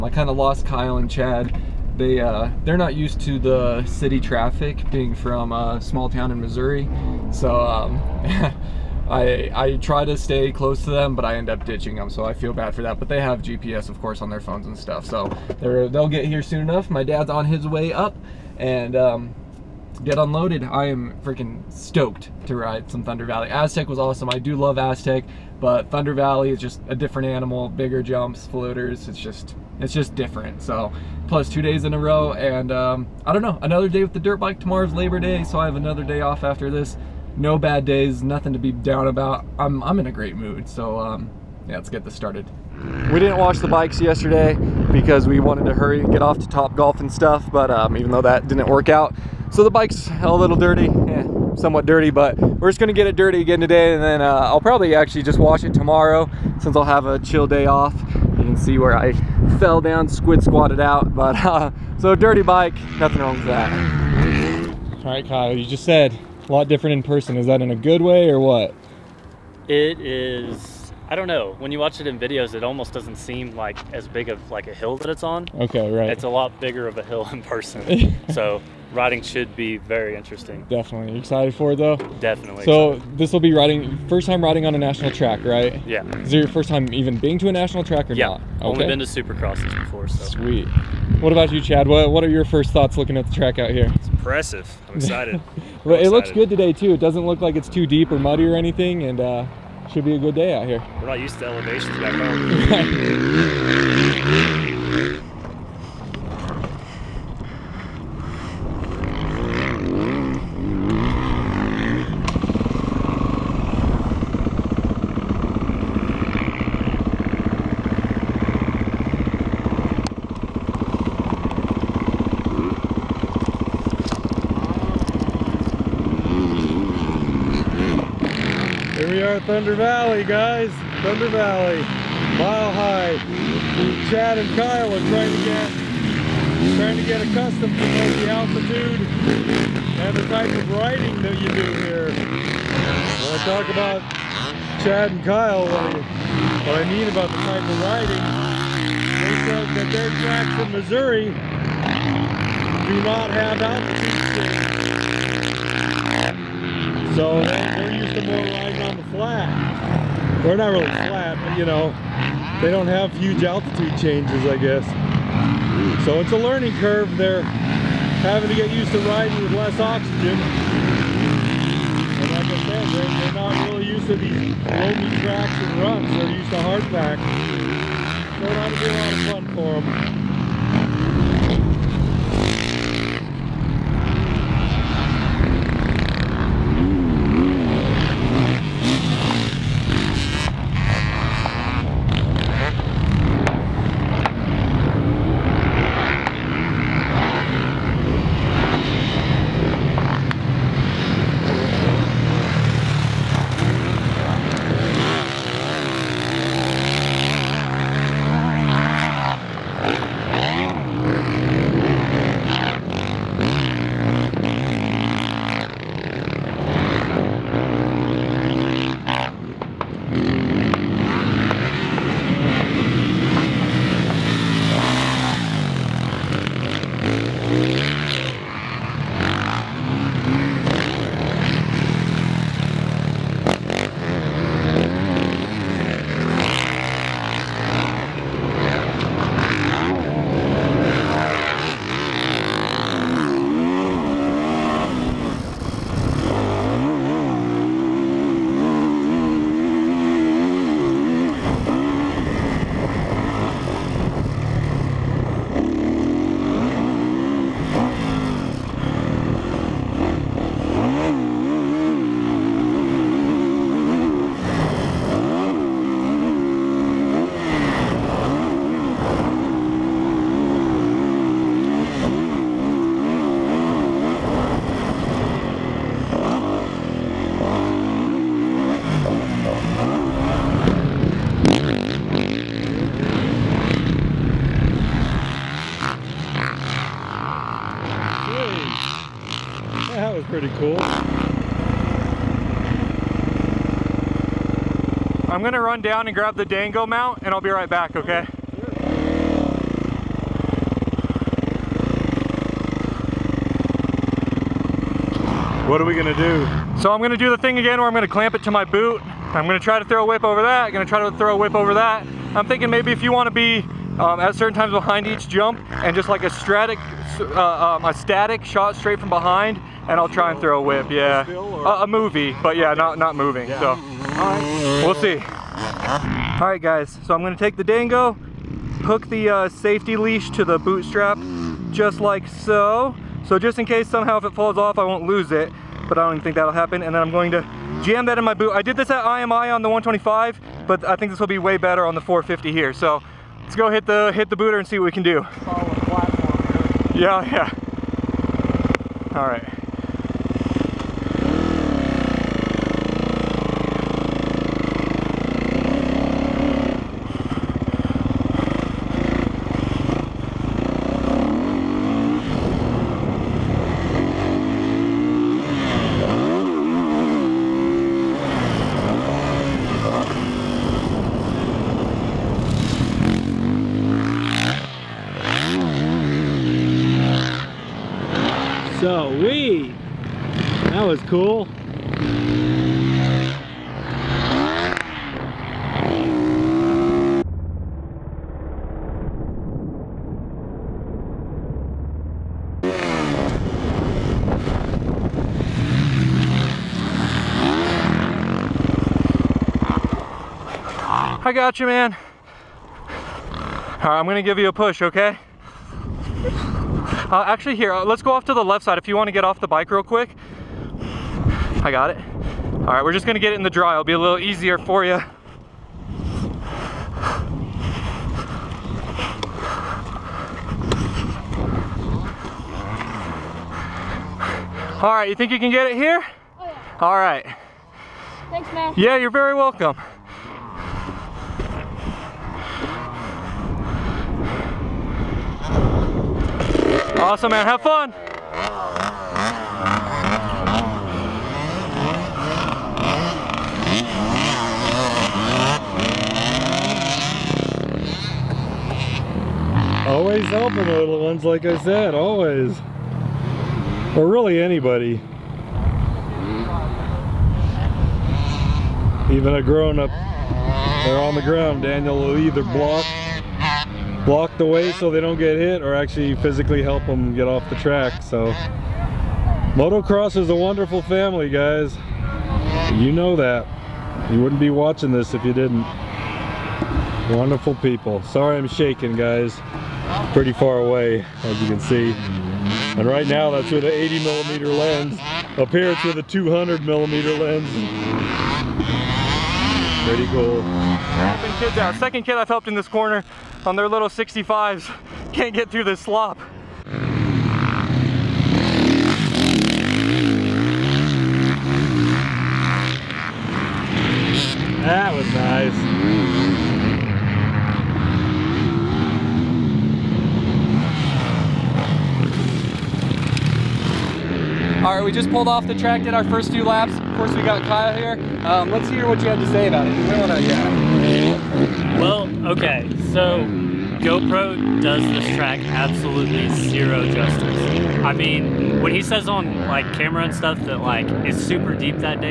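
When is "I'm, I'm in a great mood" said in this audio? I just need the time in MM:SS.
00:39.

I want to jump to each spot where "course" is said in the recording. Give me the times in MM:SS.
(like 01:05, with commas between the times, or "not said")
00:14, 08:36.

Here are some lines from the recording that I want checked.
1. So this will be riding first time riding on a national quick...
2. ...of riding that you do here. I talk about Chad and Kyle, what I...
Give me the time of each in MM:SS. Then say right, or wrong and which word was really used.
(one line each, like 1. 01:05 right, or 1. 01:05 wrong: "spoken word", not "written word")
1. 01:22 wrong: "track", not "quick"
2. 02:20 right.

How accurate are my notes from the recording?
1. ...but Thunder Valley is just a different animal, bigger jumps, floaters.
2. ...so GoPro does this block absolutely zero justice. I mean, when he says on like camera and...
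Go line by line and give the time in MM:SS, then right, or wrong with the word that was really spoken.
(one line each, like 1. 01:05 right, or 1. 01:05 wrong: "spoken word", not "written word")
1. 00:25 right
2. 08:42 wrong: "track", not "block".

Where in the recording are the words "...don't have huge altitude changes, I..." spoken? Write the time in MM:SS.
02:42.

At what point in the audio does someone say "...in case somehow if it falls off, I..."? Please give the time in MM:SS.
05:33.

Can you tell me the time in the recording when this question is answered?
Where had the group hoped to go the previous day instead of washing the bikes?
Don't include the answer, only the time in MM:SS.
00:46.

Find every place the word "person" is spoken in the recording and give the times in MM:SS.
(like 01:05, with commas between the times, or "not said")
01:07, 01:17.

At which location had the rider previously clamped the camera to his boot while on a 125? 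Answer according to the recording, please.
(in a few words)
IMI.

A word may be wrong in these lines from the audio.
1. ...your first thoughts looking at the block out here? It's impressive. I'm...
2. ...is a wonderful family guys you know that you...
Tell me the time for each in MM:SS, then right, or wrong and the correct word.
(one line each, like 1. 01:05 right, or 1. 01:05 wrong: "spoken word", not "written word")
1. 01:32 wrong: "track", not "block"
2. 07:50 right.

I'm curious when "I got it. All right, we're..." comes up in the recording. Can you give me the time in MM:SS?
06:51.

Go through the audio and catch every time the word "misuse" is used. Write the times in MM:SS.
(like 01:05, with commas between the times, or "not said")
not said.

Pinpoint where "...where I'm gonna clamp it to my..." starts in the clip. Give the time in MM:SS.
05:07.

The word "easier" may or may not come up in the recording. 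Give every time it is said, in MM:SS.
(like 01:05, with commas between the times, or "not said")
06:54.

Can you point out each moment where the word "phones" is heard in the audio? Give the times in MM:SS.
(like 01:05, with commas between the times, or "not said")
00:14.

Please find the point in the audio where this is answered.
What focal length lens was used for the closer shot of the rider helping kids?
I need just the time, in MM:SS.
08:06.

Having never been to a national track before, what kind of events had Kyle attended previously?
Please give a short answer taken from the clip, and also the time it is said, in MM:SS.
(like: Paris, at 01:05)
supercrosses, at 01:29.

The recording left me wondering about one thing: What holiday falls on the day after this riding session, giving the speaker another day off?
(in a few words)
Labor Day.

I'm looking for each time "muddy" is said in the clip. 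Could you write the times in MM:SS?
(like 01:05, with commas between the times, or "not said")
01:38.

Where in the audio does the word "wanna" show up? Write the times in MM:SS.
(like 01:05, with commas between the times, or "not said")
05:13, 06:48.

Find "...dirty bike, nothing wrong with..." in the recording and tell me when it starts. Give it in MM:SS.
01:02.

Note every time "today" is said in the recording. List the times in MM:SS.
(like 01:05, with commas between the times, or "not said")
00:53, 01:36.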